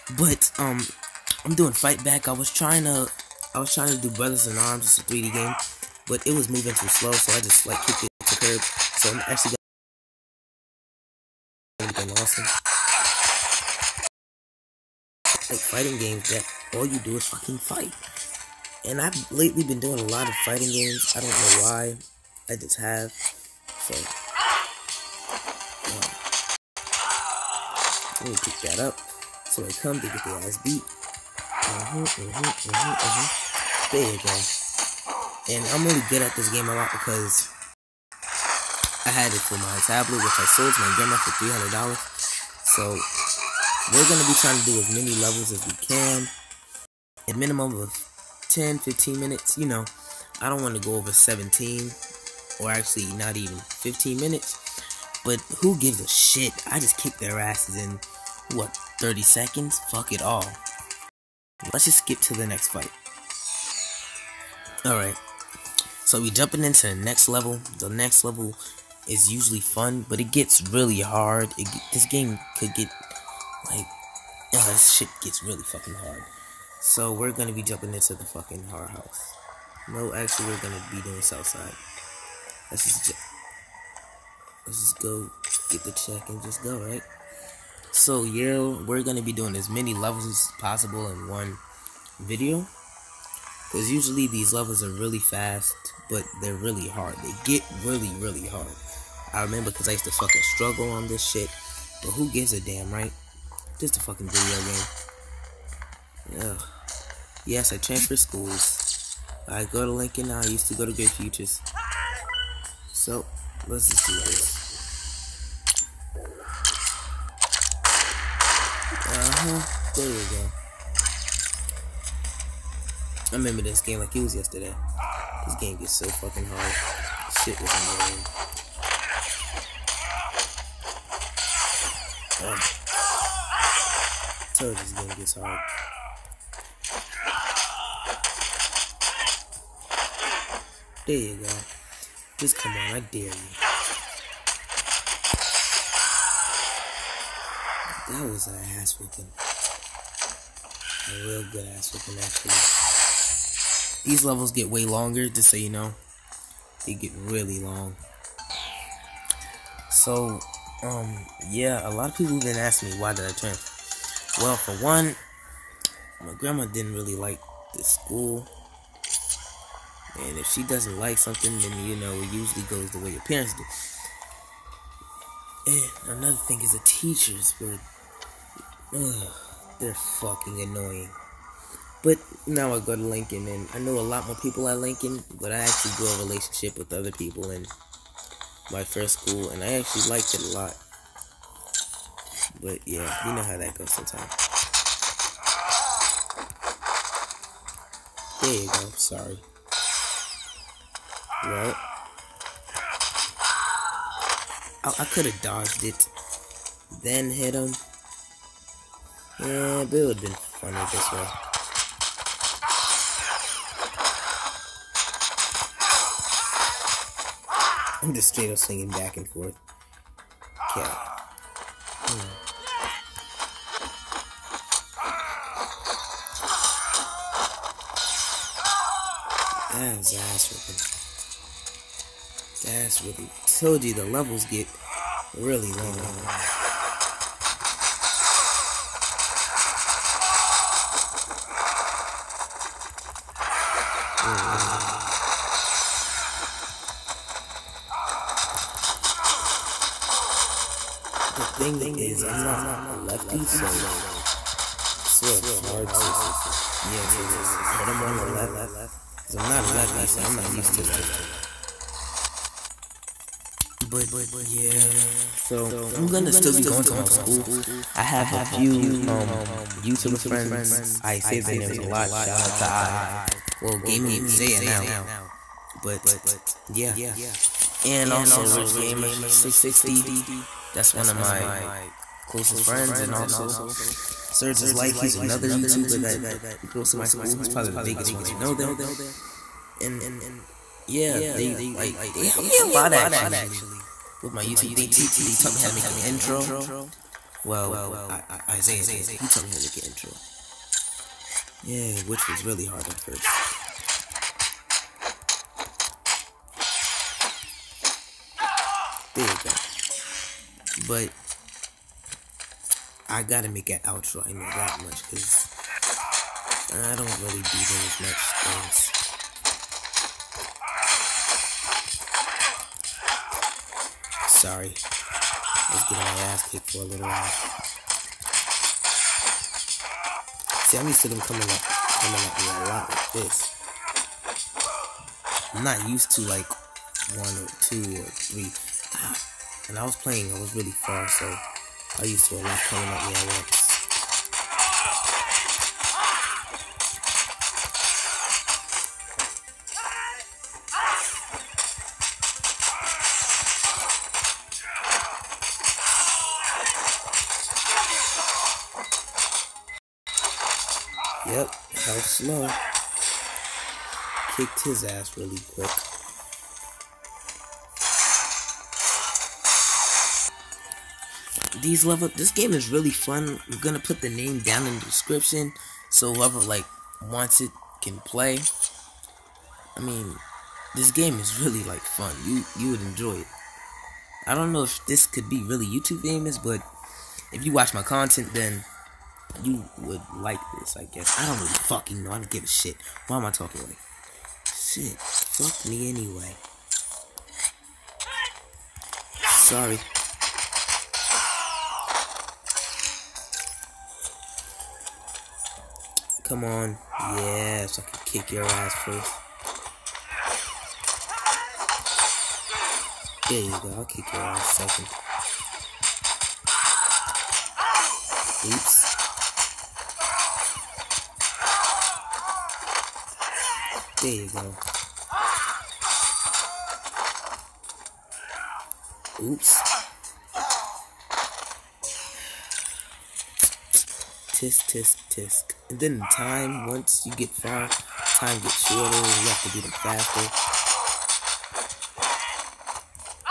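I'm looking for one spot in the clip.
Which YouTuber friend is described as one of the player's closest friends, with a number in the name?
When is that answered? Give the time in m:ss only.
4:38.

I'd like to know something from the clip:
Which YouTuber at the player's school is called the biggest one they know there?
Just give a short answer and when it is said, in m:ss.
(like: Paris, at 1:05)
Surge is Life, at 4:44.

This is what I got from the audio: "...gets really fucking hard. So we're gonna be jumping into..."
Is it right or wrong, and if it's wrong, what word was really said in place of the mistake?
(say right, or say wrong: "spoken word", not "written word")
right.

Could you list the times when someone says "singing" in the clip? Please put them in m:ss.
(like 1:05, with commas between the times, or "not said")
3:38.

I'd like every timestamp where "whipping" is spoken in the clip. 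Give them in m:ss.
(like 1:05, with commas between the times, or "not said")
3:51.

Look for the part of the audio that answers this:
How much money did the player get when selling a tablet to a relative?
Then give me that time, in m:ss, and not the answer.
0:41.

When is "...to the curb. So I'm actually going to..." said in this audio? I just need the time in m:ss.
0:08.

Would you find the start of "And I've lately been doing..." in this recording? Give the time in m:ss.
0:18.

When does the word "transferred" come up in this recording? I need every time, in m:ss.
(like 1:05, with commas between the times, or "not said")
1:47.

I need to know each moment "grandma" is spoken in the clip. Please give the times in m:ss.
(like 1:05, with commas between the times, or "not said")
0:40, 2:46.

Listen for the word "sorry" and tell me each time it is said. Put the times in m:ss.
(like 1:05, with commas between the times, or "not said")
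3:18, 5:24, 6:39.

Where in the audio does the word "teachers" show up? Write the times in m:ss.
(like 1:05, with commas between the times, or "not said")
2:56.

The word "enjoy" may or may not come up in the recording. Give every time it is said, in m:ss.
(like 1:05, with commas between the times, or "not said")
6:22.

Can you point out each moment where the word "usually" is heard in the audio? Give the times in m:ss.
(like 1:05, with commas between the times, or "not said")
1:09, 1:33, 2:52.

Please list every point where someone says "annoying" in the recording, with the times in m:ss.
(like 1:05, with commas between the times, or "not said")
2:07, 3:00.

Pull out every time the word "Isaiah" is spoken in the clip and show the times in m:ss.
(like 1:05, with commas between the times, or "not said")
4:58.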